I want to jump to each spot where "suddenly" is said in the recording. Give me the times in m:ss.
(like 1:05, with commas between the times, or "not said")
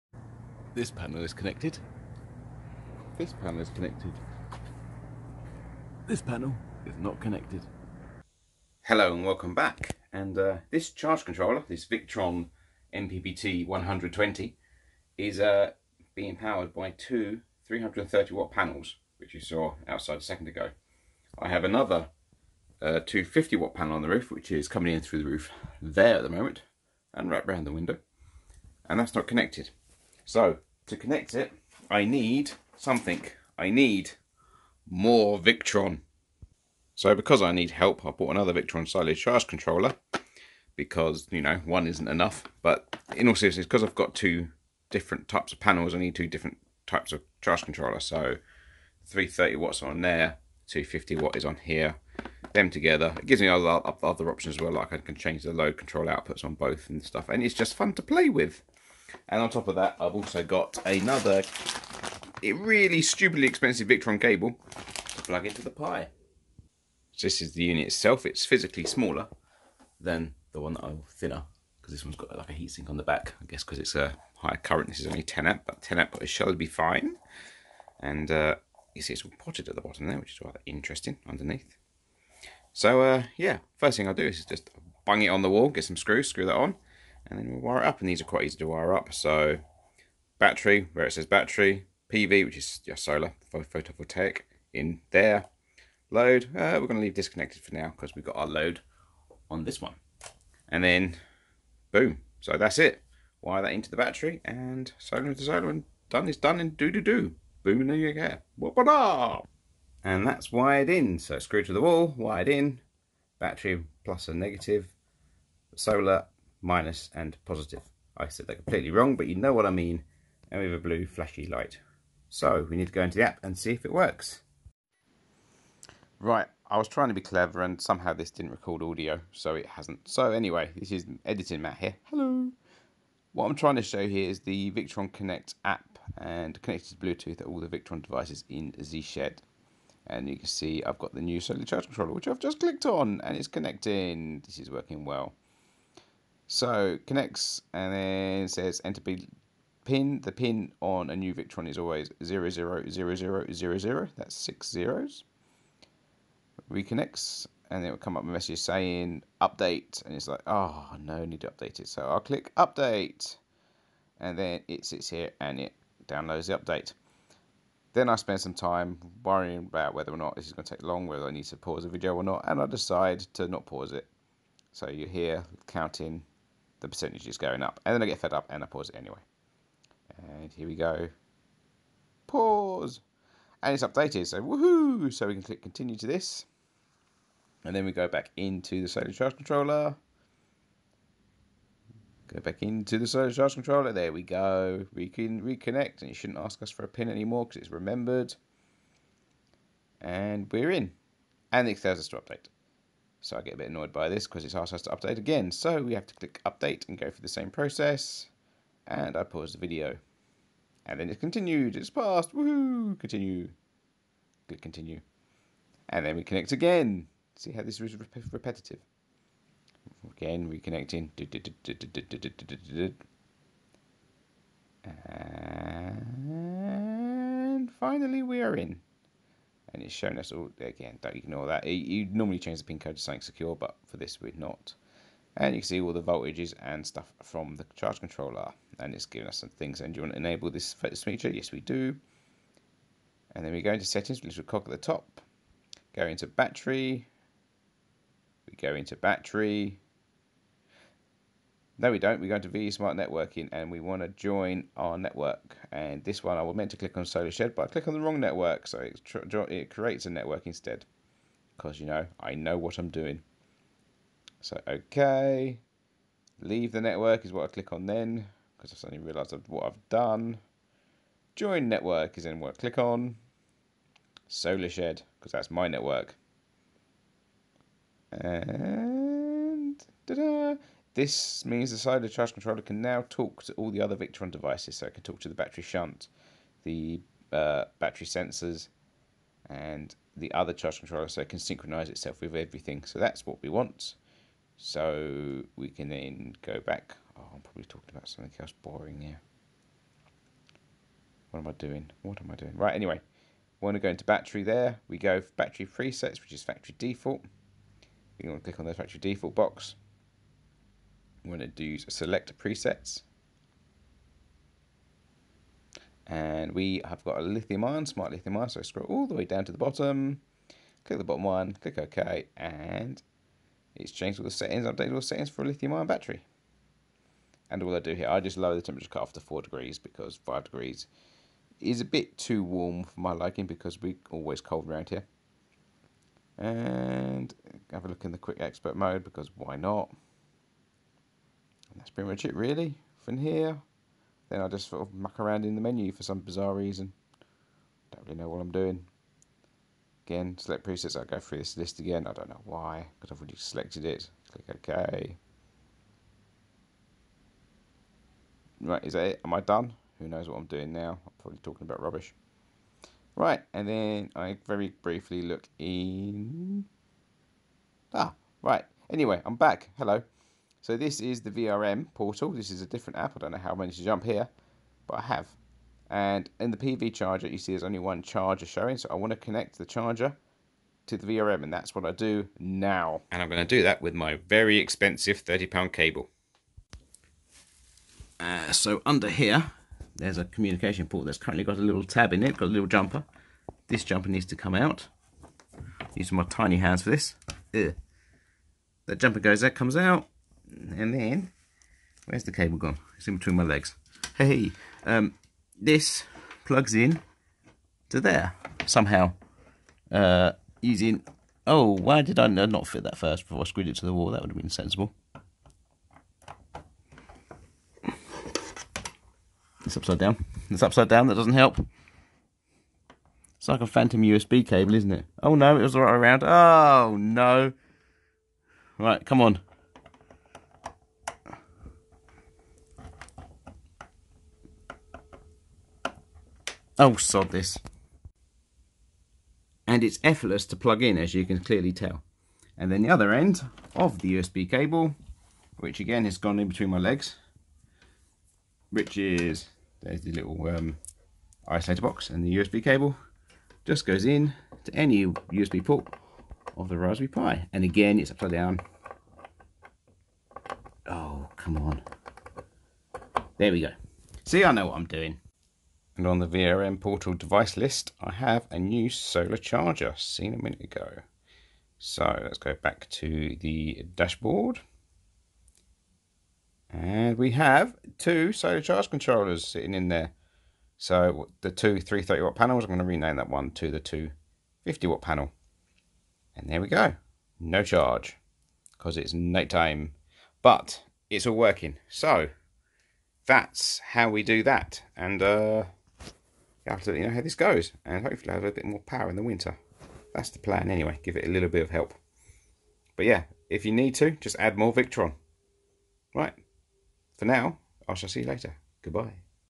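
4:28.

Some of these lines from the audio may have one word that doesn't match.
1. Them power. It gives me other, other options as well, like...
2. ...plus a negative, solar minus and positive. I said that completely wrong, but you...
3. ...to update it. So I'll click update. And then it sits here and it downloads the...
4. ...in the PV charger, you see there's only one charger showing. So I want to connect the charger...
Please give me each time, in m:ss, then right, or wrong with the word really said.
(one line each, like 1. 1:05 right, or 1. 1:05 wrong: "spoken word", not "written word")
1. 0:52 wrong: "together", not "power"
2. 1:54 right
3. 2:41 right
4. 6:16 right.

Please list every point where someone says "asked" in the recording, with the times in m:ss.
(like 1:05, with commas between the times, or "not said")
3:24.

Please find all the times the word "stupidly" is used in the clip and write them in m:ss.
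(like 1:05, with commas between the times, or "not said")
1:03.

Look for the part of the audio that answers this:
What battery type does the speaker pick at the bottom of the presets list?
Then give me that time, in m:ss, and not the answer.
5:17.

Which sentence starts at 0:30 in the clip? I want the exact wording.
So to connect it, I need something.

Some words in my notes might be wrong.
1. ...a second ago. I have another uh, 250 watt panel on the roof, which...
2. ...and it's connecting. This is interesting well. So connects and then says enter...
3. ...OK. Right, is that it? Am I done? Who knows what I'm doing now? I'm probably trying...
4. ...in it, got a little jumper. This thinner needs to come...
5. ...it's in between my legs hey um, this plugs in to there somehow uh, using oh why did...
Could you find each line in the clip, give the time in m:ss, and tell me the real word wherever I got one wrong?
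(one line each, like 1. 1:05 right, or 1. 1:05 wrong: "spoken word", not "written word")
1. 0:20 right
2. 2:23 wrong: "working", not "interesting"
3. 5:54 wrong: "talking", not "trying"
4. 6:32 wrong: "jumper", not "thinner"
5. 6:42 right.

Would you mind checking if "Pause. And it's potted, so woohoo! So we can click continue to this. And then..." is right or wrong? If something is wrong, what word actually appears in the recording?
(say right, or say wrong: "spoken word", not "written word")
wrong: "updated", not "potted".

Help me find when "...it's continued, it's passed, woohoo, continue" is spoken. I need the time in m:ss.
3:31.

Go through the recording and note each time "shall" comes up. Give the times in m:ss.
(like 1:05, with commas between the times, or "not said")
1:16, 8:27.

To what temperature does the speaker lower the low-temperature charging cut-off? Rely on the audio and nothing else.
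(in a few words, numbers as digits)
4 degrees.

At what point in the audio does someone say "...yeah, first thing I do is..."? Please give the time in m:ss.
1:23.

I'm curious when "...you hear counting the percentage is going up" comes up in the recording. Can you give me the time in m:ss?
2:54.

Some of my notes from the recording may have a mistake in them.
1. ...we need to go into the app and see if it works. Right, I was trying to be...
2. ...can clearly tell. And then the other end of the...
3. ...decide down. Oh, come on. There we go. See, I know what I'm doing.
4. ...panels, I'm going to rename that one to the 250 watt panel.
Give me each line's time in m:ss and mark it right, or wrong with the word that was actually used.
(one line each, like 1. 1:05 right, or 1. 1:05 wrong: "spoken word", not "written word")
1. 2:02 right
2. 7:21 right
3. 7:38 wrong: "upside", not "decide"
4. 8:02 right.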